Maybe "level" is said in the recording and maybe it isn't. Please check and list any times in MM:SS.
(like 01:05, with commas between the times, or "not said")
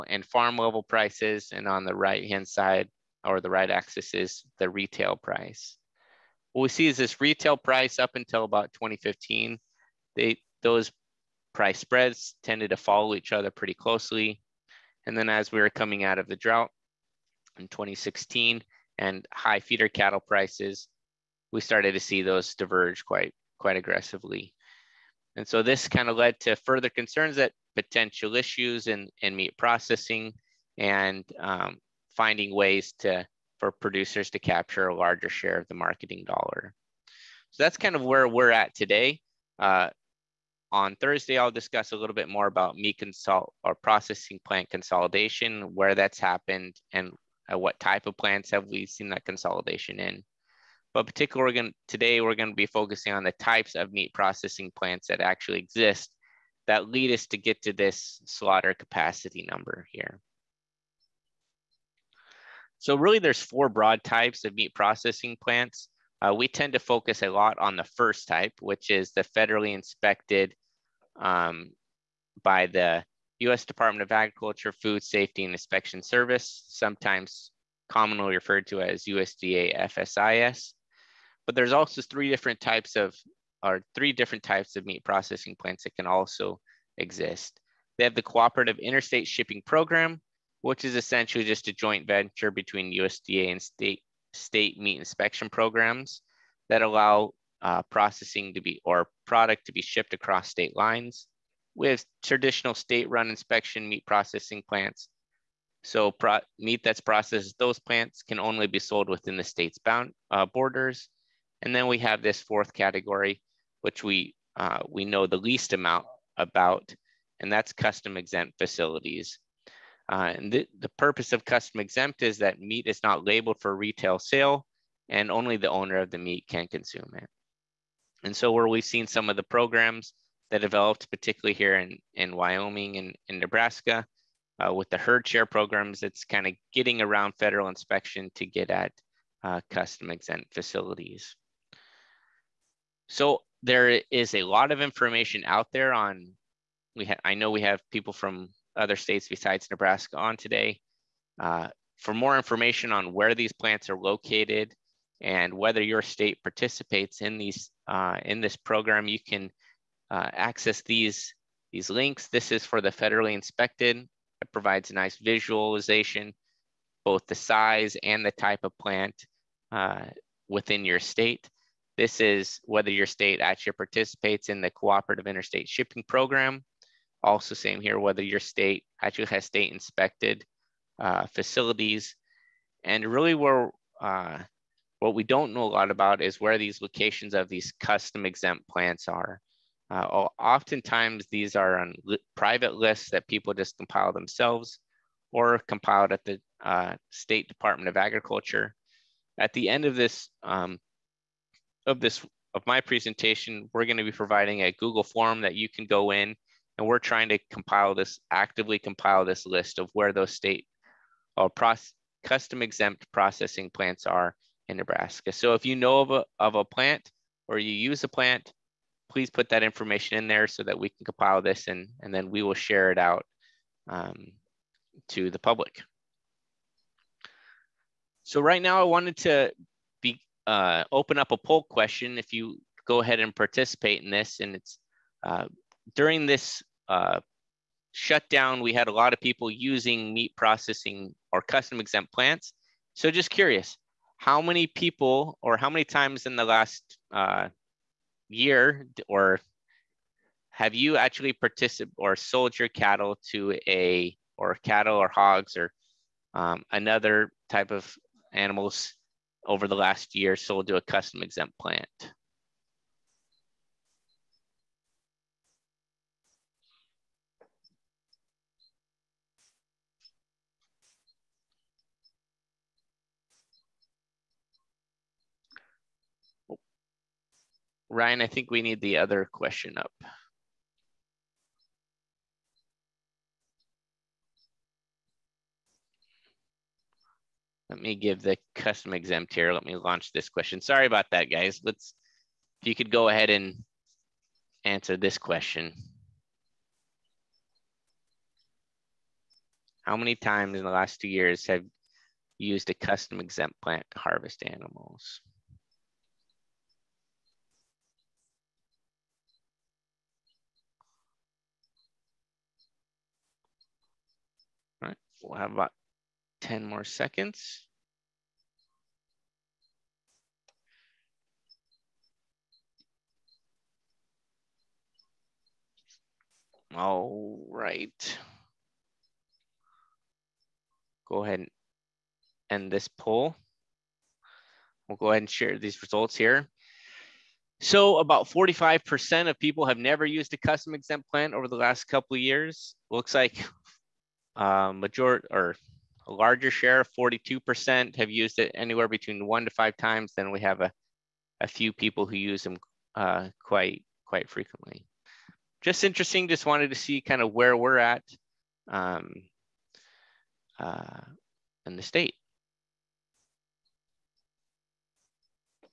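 00:00.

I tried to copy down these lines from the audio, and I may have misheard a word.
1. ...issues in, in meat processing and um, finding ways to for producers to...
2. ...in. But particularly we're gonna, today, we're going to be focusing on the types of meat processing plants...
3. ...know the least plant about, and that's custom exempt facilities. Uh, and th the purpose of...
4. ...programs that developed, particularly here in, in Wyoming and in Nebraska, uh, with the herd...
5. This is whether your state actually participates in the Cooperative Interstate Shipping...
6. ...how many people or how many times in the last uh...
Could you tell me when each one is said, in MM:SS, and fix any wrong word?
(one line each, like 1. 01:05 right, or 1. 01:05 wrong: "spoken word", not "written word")
1. 00:28 right
2. 00:49 right
3. 01:55 wrong: "amount", not "plant"
4. 02:09 right
5. 02:51 right
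6. 04:04 right.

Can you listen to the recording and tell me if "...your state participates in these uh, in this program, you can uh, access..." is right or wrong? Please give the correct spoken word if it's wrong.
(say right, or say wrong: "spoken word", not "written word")
right.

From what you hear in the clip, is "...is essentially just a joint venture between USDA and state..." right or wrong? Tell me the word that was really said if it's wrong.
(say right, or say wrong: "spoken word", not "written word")
right.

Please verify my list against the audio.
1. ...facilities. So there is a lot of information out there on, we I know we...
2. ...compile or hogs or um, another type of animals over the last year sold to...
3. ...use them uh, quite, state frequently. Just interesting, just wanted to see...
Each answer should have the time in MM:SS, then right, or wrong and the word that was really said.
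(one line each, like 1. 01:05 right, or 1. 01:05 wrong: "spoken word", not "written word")
1. 02:20 right
2. 04:14 wrong: "cattle", not "compile"
3. 05:52 wrong: "quite", not "state".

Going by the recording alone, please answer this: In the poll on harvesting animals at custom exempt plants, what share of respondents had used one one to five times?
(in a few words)
42%.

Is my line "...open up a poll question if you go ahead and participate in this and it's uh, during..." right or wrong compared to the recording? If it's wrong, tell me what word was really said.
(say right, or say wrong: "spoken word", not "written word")
right.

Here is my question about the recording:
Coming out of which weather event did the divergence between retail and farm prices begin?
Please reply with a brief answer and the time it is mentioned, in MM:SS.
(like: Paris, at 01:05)
the drought in 2016, at 00:16.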